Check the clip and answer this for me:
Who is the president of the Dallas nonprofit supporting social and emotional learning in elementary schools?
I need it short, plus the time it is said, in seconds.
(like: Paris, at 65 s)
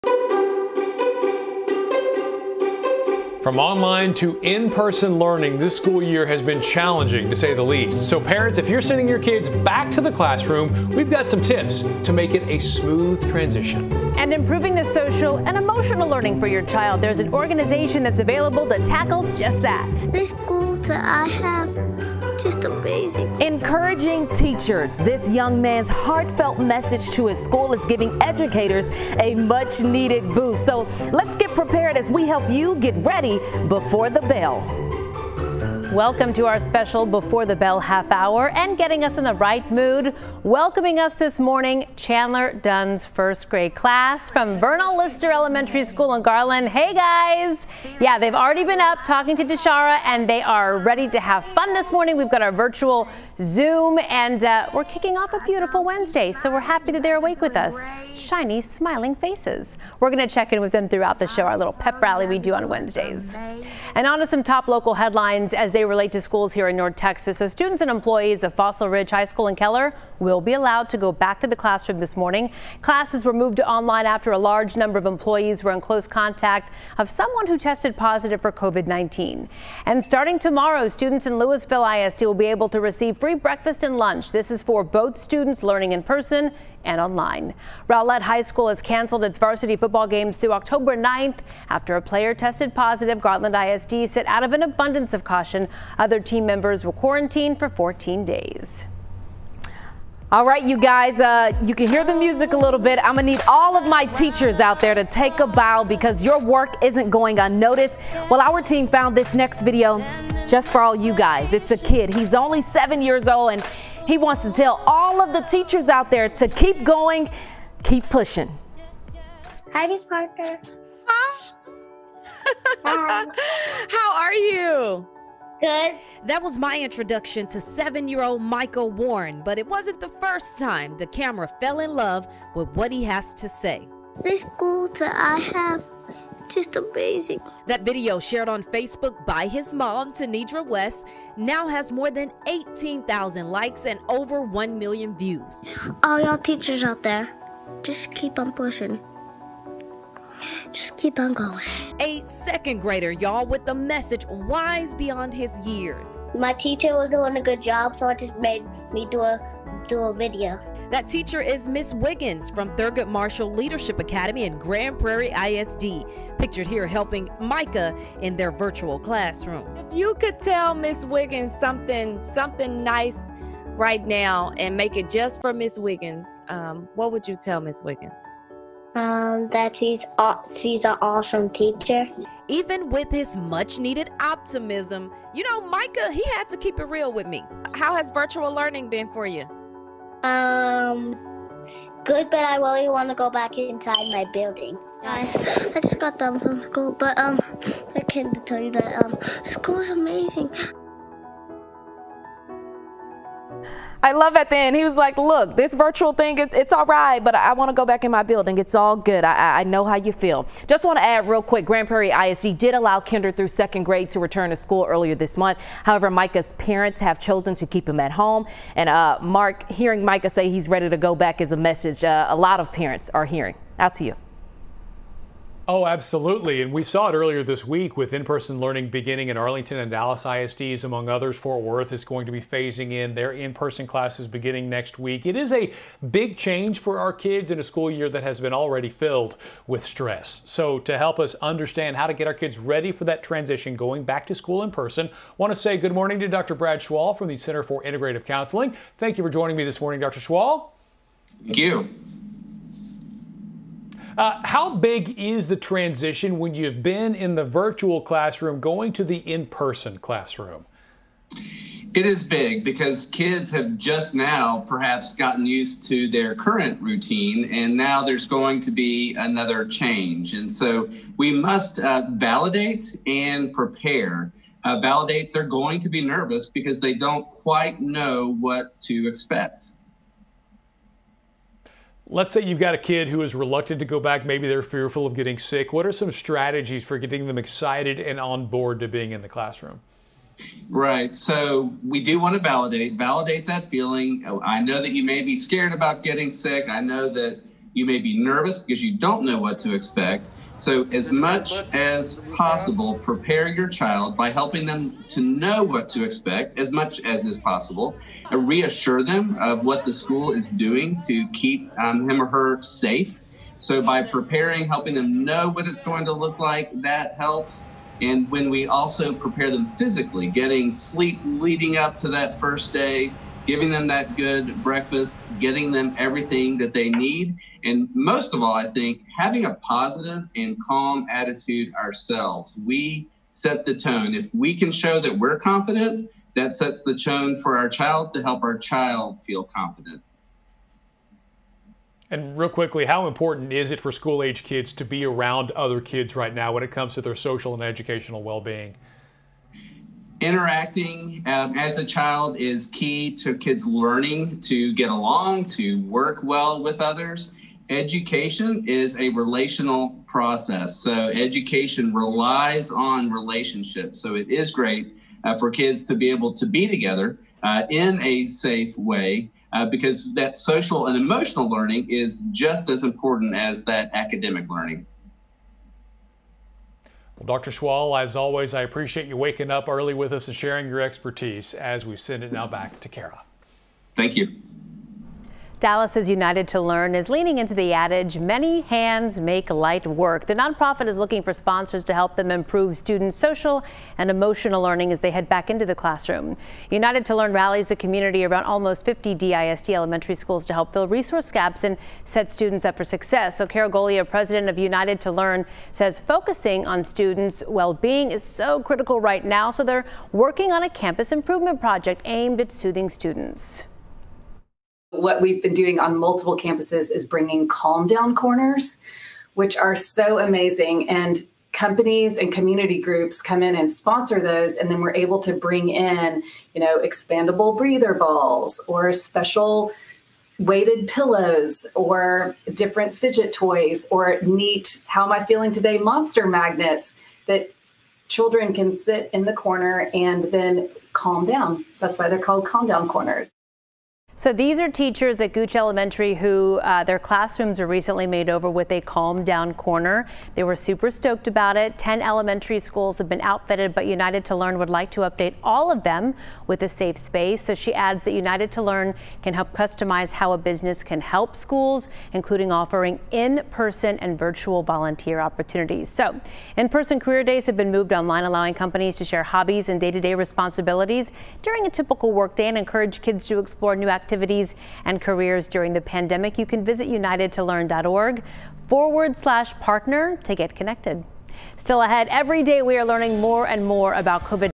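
Carol Golia, at 403 s.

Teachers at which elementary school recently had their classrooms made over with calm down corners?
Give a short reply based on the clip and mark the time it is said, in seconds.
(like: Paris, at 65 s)
Gooch Elementary, at 445 s.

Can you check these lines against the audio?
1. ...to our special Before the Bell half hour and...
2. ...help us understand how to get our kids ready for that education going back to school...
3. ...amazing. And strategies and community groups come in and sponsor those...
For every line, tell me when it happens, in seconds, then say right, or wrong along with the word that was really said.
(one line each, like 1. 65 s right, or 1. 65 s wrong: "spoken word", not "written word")
1. 36 s right
2. 240 s wrong: "transition", not "education"
3. 420 s wrong: "companies", not "strategies".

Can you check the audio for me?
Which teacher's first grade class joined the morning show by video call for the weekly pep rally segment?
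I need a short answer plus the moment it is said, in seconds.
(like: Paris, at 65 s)
Chandler Dunn, at 41 s.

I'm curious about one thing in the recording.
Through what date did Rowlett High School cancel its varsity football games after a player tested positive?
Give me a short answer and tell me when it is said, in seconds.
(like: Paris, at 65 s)
October 9th, at 90 s.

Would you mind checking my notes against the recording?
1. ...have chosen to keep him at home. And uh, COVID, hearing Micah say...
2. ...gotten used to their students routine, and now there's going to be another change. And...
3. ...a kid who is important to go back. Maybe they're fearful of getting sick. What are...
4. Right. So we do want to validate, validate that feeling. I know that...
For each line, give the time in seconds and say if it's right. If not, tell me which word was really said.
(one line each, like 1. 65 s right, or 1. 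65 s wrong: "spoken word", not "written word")
1. 216 s wrong: "Mark", not "COVID"
2. 265 s wrong: "current", not "students"
3. 282 s wrong: "reluctant", not "important"
4. 290 s right.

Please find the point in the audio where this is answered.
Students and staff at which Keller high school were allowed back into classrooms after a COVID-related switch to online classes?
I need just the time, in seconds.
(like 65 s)
68 s.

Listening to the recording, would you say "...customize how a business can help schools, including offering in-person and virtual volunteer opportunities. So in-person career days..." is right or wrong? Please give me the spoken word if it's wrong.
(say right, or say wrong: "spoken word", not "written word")
right.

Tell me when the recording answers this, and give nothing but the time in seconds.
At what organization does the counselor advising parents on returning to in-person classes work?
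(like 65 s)
247 s.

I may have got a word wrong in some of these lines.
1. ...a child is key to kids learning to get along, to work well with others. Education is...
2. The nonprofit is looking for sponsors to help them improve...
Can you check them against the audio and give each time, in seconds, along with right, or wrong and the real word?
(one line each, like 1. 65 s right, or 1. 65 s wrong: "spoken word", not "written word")
1. 351 s right
2. 390 s right.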